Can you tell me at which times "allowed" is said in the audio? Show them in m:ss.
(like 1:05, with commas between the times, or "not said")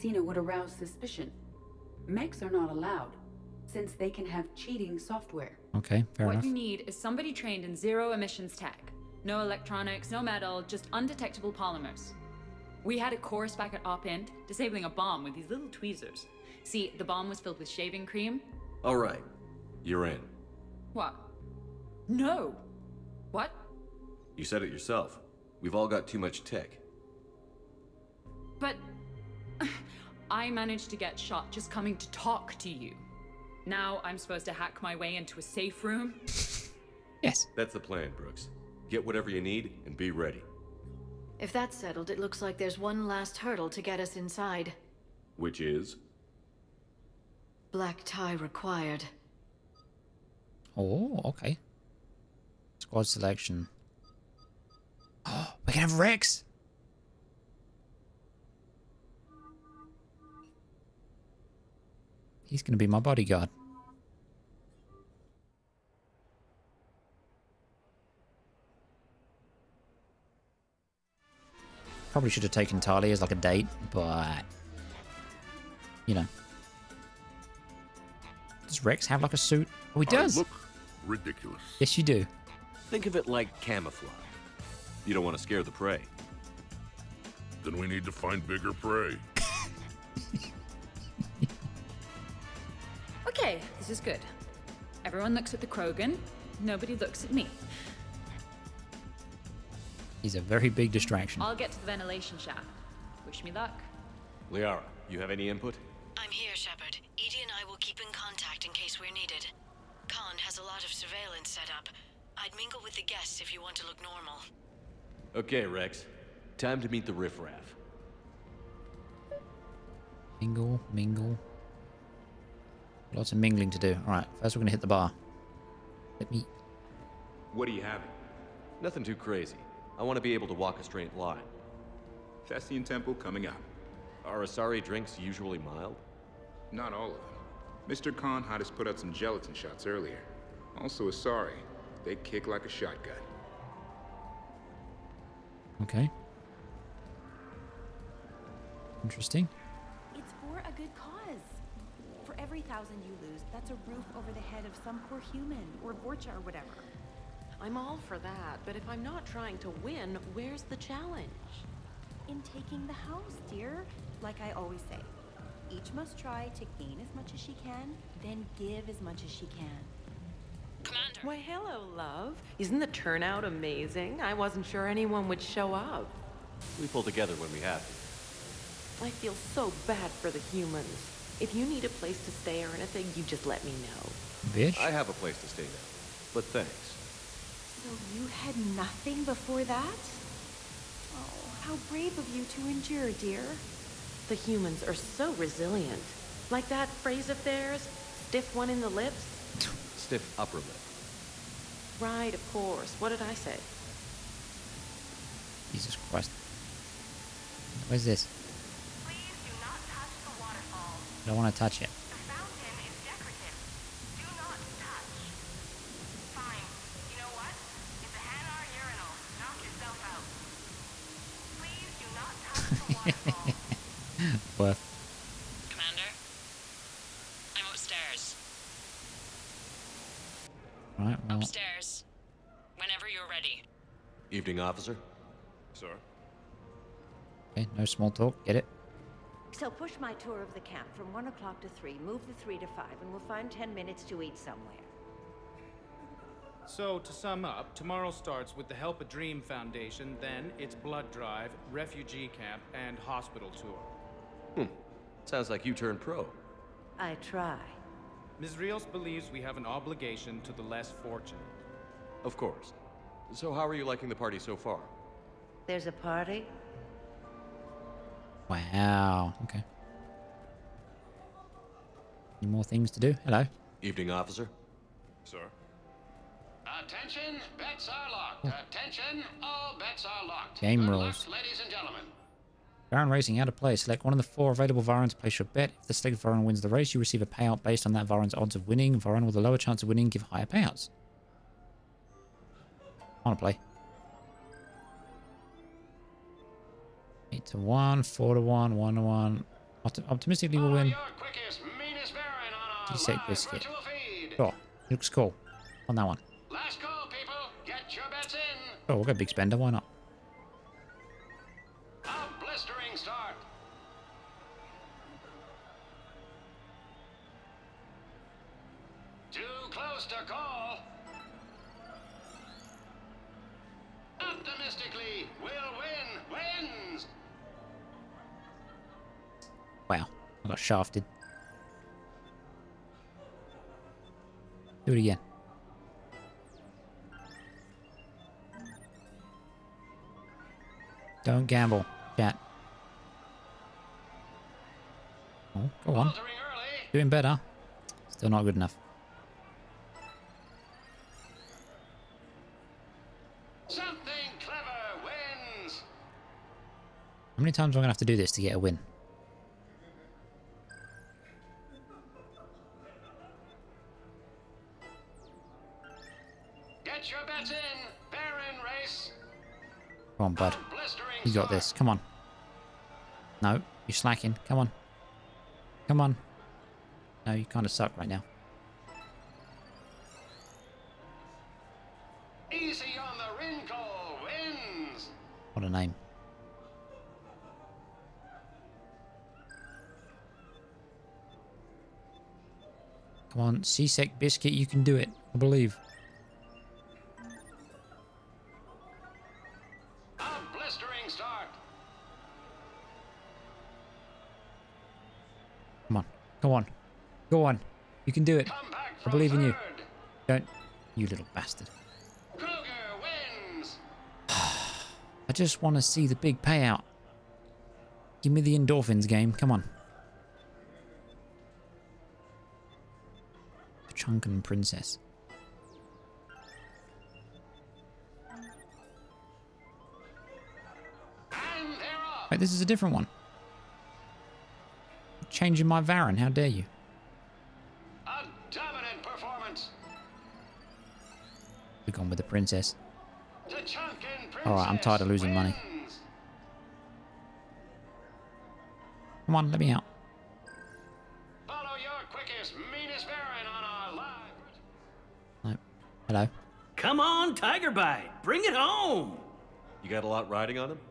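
0:02.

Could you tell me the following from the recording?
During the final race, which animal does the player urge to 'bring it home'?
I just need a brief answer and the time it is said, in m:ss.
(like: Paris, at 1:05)
Tiger Bite, at 7:37.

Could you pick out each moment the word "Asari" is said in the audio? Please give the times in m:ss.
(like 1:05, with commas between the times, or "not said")
2:14, 2:21.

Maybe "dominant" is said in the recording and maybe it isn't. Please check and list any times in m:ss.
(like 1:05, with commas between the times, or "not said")
7:18.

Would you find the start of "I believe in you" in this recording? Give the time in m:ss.
6:49.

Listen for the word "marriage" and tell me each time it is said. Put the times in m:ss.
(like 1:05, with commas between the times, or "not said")
not said.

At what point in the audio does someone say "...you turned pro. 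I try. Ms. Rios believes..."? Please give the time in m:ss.
4:15.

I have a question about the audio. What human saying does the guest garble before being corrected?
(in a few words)
stiff upper lip.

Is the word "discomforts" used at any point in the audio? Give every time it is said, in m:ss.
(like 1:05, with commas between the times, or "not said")
not said.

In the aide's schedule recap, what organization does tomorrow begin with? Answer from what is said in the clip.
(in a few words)
Help a Dream Foundation.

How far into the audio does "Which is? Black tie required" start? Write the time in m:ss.
0:45.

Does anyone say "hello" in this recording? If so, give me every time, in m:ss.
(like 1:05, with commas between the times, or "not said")
2:51, 4:33, 7:36.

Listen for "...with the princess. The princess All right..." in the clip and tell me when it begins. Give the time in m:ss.
7:22.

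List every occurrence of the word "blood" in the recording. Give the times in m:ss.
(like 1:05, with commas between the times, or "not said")
4:10.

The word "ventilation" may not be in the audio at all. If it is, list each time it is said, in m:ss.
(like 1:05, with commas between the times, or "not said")
1:41.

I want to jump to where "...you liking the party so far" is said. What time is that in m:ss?
4:23.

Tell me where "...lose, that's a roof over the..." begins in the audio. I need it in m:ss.
2:33.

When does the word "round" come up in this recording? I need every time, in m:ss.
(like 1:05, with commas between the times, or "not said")
not said.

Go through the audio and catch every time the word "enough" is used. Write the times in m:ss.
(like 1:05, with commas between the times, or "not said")
0:06, 5:48.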